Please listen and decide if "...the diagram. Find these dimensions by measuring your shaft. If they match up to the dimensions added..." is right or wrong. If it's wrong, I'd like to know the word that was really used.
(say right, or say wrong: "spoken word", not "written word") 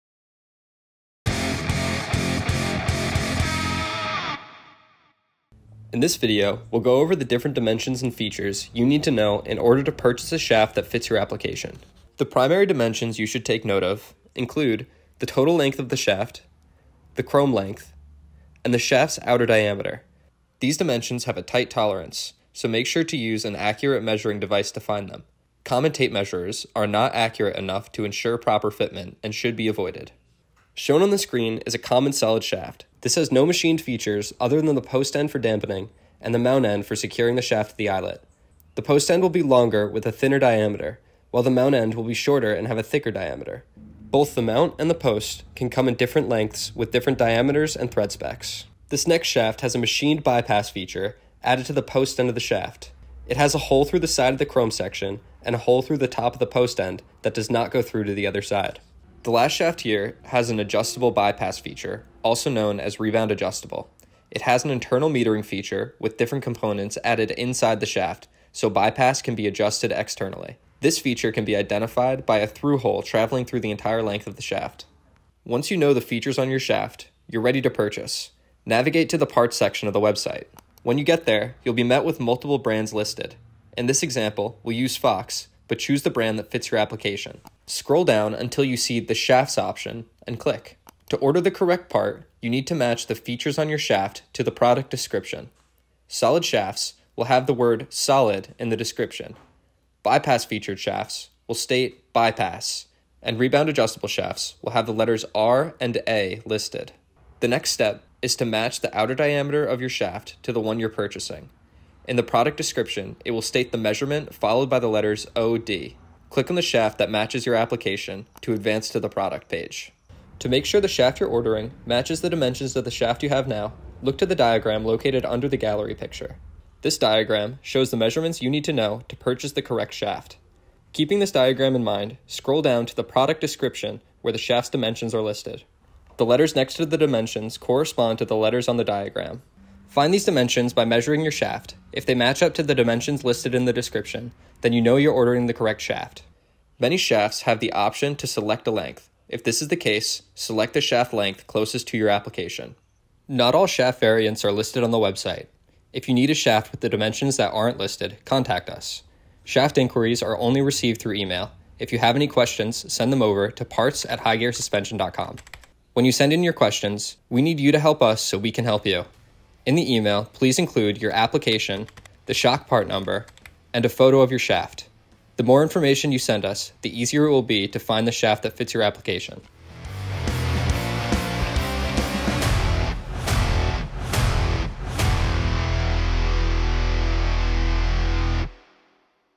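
wrong: "listed", not "added".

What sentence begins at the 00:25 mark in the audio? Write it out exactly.
Common tape measurers are not accurate enough to ensure proper fitment and should be avoided.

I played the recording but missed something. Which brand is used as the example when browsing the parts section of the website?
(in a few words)
Fox.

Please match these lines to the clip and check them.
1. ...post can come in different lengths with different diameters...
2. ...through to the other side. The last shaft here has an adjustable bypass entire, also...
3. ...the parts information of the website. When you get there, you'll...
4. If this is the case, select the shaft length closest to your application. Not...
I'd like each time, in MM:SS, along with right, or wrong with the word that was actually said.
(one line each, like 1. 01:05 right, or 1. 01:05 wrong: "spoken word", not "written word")
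1. 00:44 right
2. 00:57 wrong: "feature", not "entire"
3. 01:19 wrong: "section", not "information"
4. 02:29 right.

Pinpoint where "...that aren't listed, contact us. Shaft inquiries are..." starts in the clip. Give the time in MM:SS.
02:37.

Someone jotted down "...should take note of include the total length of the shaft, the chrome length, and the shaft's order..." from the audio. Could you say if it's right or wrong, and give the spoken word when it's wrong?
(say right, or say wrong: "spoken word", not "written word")
wrong: "outer", not "order".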